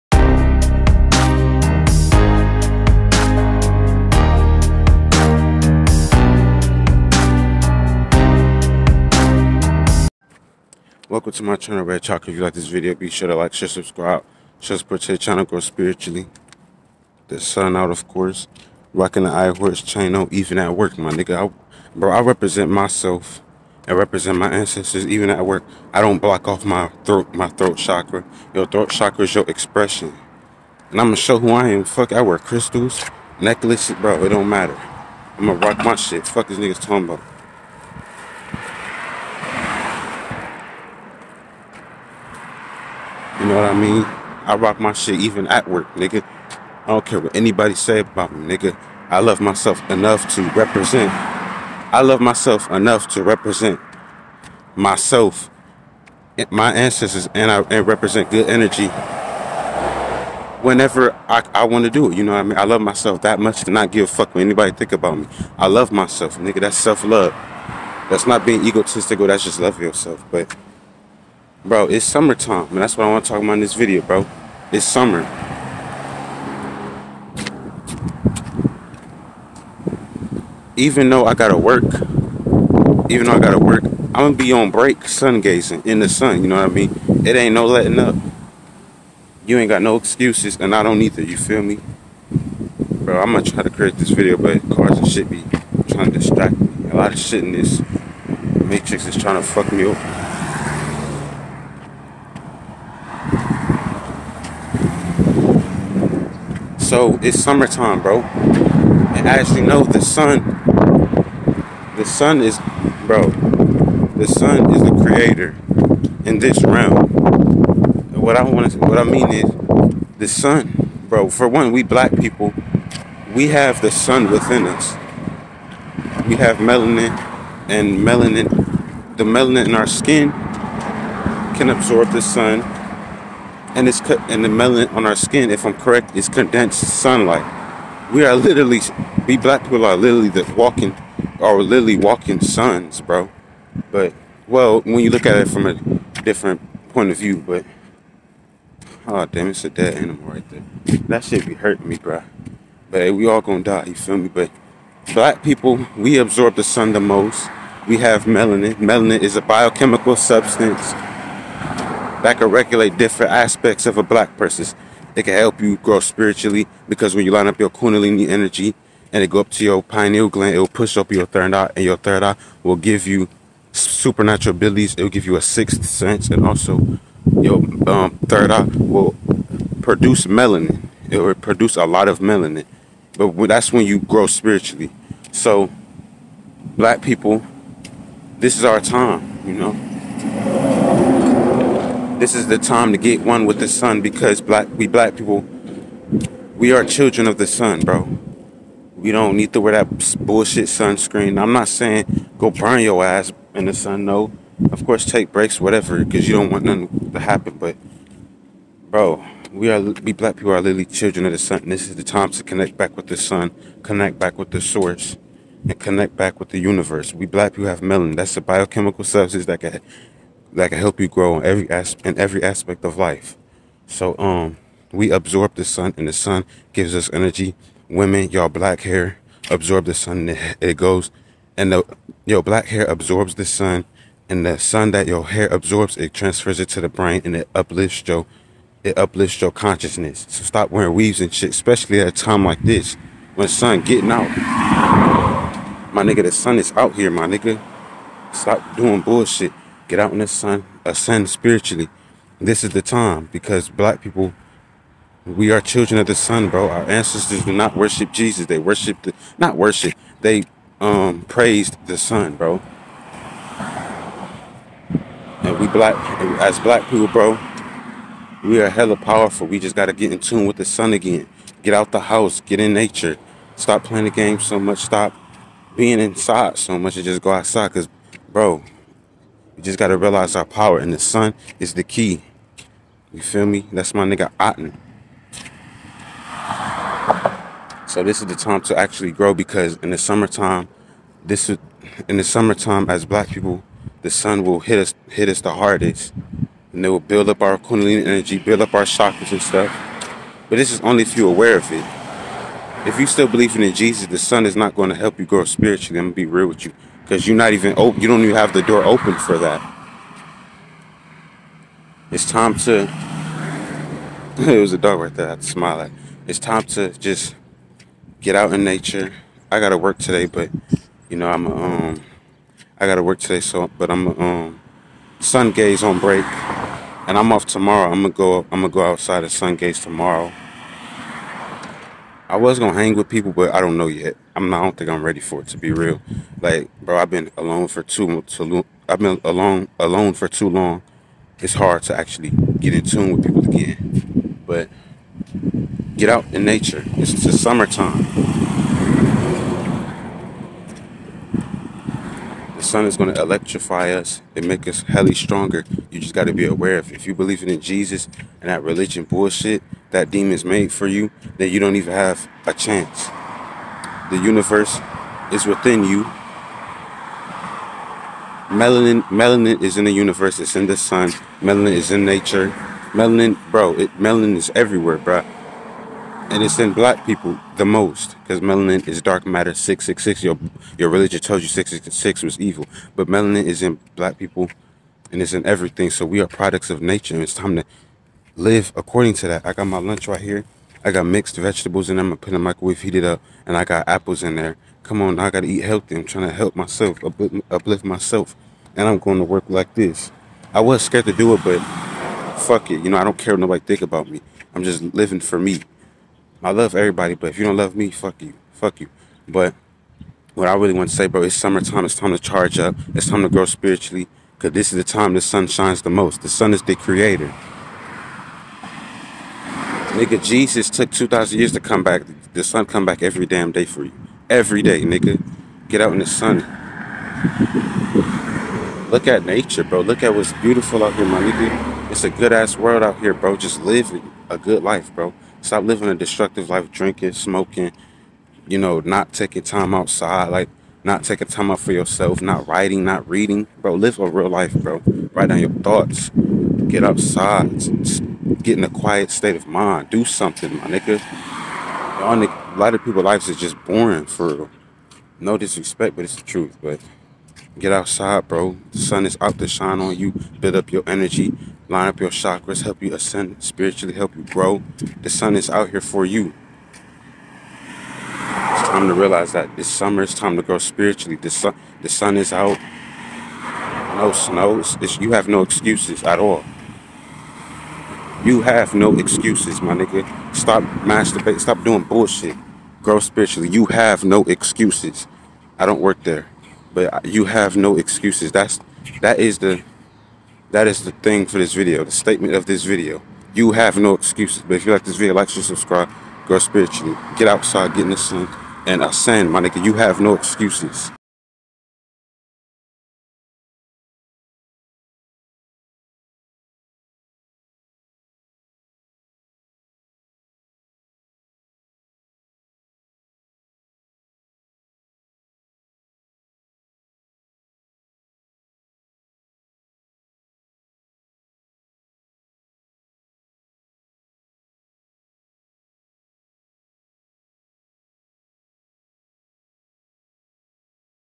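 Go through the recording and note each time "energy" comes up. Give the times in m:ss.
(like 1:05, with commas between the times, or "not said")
0:58, 2:48, 3:47, 4:58, 7:40.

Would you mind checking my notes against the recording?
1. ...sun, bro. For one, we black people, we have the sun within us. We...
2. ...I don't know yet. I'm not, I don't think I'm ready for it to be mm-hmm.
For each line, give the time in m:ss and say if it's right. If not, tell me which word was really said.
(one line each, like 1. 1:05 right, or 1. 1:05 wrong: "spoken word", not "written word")
1. 2:00 right
2. 5:33 right.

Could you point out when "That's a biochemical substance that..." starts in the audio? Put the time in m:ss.
3:38.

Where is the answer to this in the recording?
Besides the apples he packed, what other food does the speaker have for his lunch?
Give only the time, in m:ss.
6:31.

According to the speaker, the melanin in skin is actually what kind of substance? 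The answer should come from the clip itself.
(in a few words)
Condensed sunlight.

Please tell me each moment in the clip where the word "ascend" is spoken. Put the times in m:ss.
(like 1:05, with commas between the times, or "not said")
4:10, 7:42.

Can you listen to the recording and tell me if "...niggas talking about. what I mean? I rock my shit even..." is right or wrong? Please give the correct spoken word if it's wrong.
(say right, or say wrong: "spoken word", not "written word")
right.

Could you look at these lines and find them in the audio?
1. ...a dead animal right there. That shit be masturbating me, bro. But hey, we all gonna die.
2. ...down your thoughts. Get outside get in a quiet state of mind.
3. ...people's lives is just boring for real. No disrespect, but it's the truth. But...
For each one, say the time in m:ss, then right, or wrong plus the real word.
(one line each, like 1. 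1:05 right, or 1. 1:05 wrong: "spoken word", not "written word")
1. 2:29 wrong: "hurting", not "masturbating"
2. 7:25 right
3. 7:32 right.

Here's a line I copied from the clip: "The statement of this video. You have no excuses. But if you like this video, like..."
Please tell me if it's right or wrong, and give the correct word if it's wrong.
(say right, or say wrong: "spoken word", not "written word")
right.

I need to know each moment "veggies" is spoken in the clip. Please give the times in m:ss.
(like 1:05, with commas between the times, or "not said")
not said.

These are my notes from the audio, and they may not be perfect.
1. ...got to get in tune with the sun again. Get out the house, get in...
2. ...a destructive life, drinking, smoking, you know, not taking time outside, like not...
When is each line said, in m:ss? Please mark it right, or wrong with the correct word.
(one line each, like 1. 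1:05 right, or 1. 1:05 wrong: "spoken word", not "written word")
1. 4:29 right
2. 7:15 right.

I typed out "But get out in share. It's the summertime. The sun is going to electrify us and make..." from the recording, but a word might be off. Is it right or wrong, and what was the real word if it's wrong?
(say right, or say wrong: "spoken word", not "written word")
wrong: "nature", not "share".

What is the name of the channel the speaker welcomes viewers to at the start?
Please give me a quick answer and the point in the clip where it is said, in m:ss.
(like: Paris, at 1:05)
Red Chakra, at 0:11.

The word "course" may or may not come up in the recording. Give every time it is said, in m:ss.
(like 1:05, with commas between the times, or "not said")
0:18, 3:24.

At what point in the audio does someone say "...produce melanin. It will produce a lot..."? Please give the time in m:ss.
2:59.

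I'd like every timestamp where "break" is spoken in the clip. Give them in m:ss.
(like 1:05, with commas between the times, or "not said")
1:24, 3:25, 5:25.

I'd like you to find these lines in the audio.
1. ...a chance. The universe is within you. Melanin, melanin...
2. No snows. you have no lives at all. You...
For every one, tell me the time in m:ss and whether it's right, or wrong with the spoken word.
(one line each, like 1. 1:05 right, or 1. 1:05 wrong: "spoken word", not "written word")
1. 6:02 right
2. 7:53 wrong: "excuses", not "lives".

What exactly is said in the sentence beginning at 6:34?
Come on, I gotta eat healthy.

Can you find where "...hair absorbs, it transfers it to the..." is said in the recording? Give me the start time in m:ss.
3:55.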